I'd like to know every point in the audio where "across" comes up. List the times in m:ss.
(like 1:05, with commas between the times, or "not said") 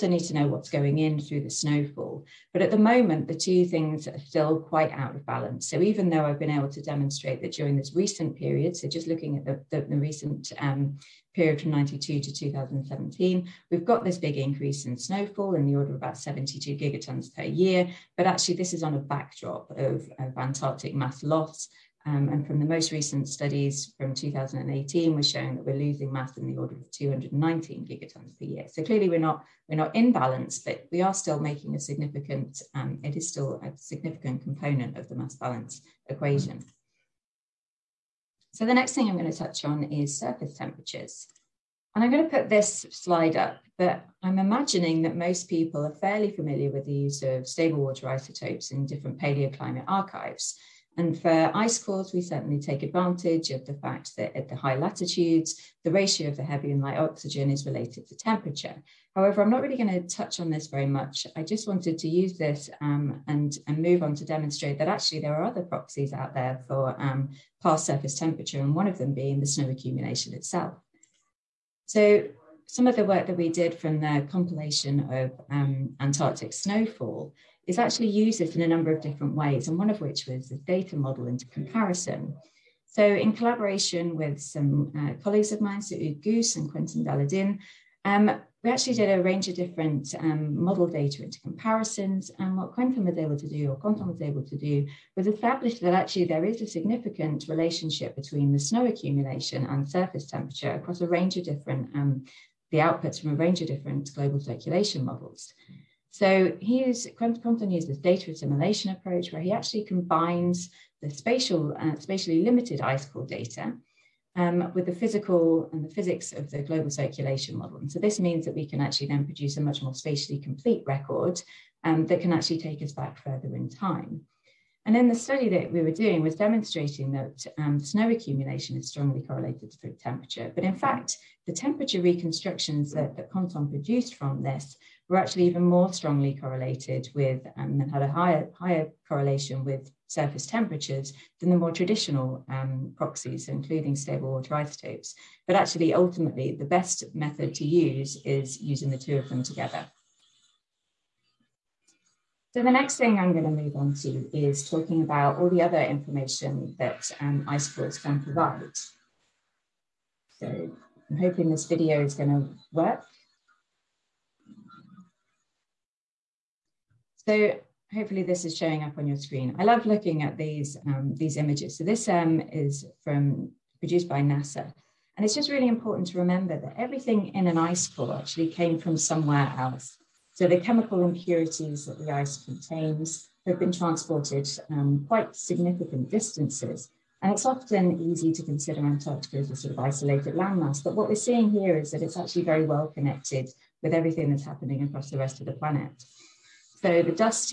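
1:40, 3:14.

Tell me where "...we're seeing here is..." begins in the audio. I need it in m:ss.
3:11.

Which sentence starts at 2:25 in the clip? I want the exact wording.
But actually, ultimately, the best method to use is using the two of them together.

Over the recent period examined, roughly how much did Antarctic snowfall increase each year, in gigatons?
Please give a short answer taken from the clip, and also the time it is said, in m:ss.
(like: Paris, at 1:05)
72 gigatons per year, at 0:16.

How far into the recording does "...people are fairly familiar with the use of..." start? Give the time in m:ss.
0:45.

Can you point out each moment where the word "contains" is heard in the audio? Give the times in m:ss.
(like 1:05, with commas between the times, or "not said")
3:02.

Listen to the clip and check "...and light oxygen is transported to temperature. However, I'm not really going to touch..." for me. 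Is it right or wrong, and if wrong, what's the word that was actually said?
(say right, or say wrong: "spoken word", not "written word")
wrong: "related", not "transported".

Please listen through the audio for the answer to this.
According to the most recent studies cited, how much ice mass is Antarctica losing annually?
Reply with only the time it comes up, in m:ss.
0:26.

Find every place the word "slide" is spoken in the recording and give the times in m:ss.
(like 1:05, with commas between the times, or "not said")
0:42.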